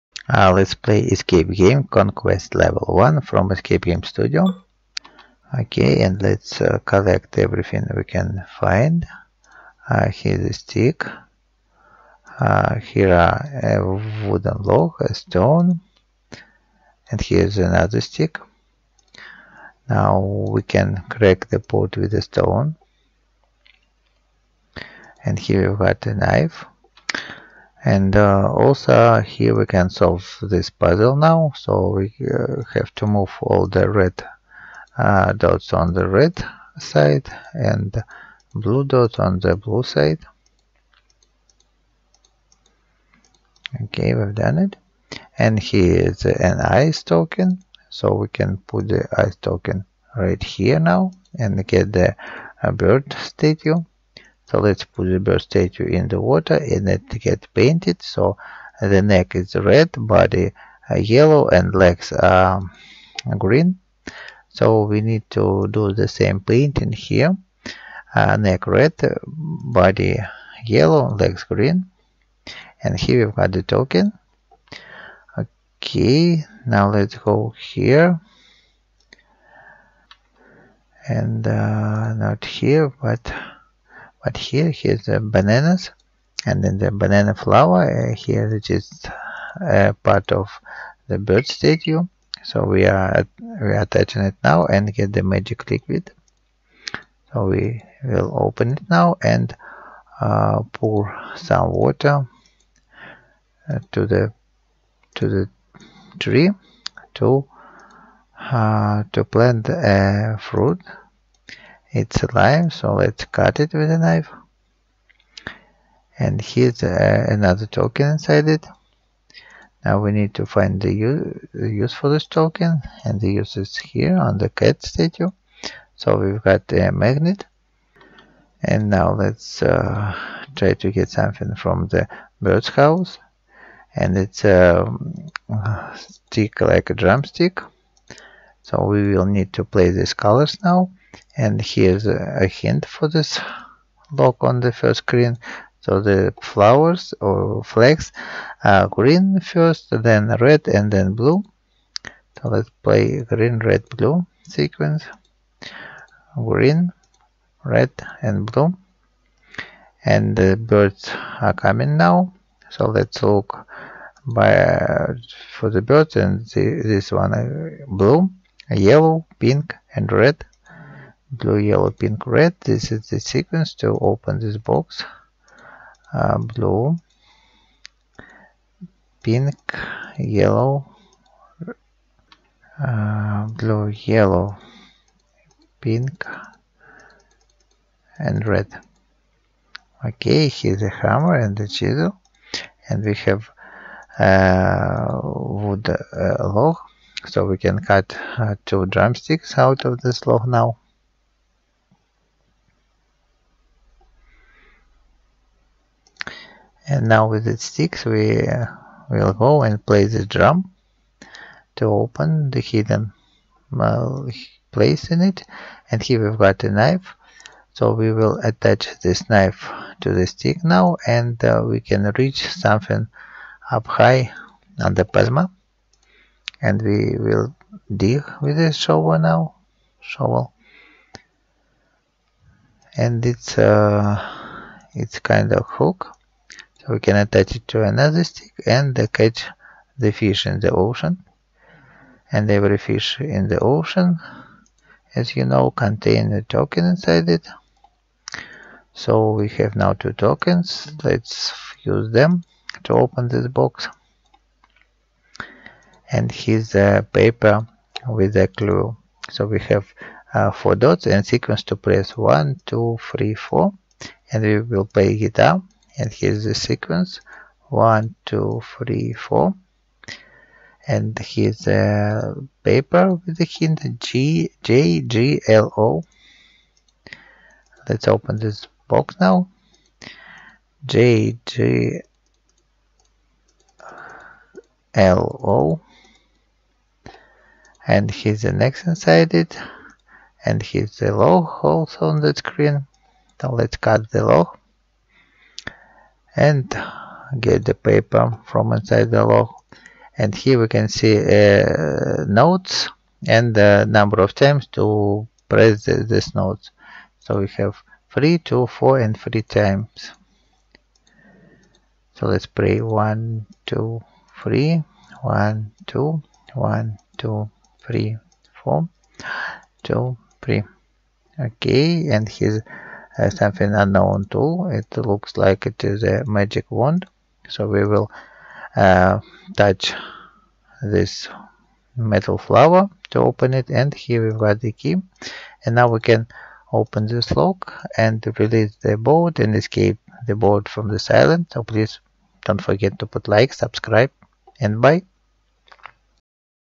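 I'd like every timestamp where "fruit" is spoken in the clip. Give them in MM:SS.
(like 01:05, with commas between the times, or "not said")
01:50.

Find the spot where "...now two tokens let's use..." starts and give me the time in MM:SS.
04:09.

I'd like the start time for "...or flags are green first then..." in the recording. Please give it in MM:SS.
02:27.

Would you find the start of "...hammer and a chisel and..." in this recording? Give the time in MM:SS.
03:10.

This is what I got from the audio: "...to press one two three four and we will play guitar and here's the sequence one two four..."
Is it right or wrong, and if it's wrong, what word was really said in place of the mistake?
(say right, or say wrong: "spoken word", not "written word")
wrong: "three", not "four".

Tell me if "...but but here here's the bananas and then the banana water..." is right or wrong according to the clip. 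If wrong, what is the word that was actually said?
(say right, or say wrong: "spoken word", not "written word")
wrong: "flower", not "water".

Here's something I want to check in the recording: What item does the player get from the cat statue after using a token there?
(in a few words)
A magnet.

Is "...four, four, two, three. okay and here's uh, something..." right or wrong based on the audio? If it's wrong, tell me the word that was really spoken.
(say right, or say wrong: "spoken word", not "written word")
wrong: "three", not "four".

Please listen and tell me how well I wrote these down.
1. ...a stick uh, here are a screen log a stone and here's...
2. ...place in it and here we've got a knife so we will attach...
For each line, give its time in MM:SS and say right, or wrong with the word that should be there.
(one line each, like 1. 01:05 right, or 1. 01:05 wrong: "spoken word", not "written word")
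1. 00:10 wrong: "wooden", not "screen"
2. 03:34 right.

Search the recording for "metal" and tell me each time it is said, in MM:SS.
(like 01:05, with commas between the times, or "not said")
05:31.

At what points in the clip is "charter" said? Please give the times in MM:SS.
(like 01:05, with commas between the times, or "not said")
not said.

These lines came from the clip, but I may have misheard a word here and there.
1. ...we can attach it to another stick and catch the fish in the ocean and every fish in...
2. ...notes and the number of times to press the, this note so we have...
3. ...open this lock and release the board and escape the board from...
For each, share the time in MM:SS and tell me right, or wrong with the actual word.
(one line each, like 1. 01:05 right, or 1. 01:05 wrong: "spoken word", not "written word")
1. 03:56 right
2. 05:02 right
3. 05:36 right.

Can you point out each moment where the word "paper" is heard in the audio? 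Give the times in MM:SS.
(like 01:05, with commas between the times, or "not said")
04:17, 04:32, 04:57.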